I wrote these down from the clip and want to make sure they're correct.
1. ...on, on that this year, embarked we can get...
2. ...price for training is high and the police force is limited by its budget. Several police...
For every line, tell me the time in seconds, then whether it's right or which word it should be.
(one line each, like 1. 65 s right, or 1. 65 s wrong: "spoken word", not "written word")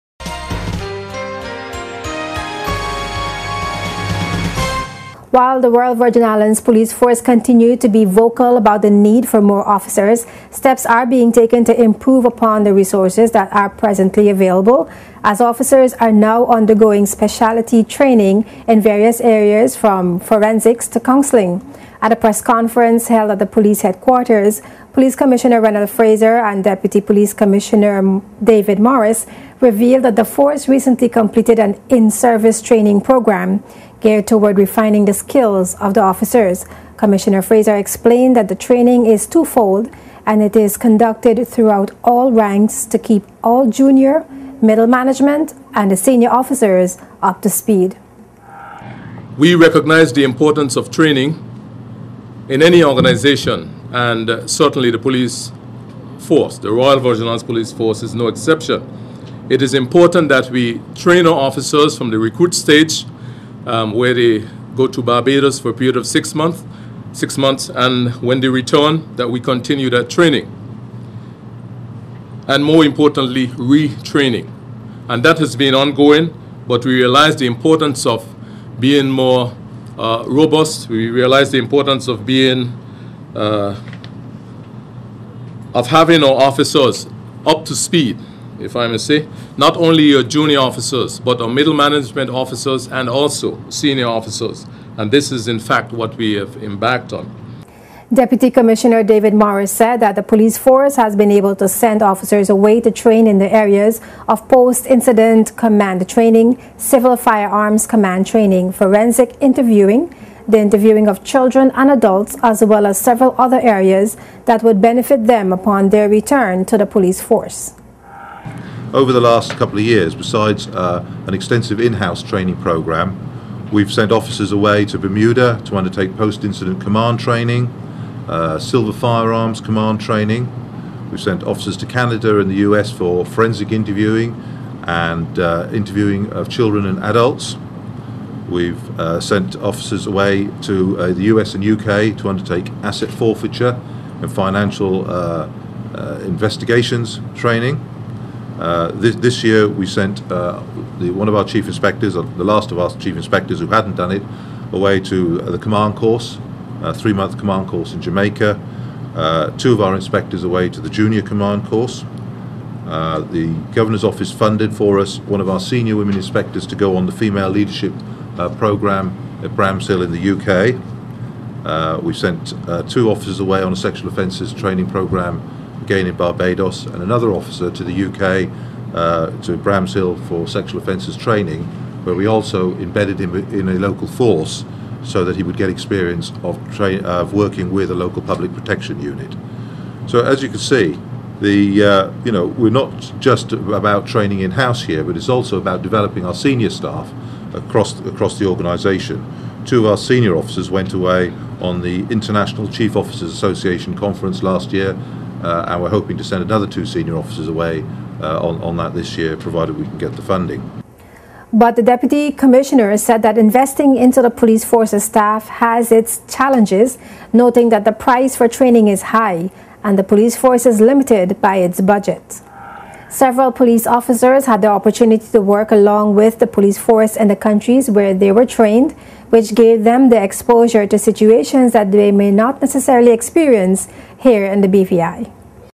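1. 208 s wrong: "provided", not "embarked"
2. 217 s right.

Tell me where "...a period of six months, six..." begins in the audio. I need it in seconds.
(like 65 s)
65 s.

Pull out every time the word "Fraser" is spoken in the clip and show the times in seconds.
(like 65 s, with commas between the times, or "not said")
25 s, 37 s.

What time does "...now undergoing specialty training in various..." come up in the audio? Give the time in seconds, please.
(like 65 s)
16 s.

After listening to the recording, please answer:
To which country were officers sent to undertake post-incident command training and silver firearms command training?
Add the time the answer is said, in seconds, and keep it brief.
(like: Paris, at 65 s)
Bermuda, at 124 s.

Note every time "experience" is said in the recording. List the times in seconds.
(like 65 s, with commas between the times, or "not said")
185 s, 233 s.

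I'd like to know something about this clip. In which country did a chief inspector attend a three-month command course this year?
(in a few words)
Jamaica.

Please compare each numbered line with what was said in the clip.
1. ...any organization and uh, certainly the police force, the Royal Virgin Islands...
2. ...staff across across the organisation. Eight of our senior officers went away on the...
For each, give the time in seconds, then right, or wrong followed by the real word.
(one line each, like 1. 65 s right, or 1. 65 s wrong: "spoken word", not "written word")
1. 52 s right
2. 196 s wrong: "Two", not "Eight".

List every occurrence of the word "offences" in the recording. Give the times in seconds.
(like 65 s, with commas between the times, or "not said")
174 s, 180 s.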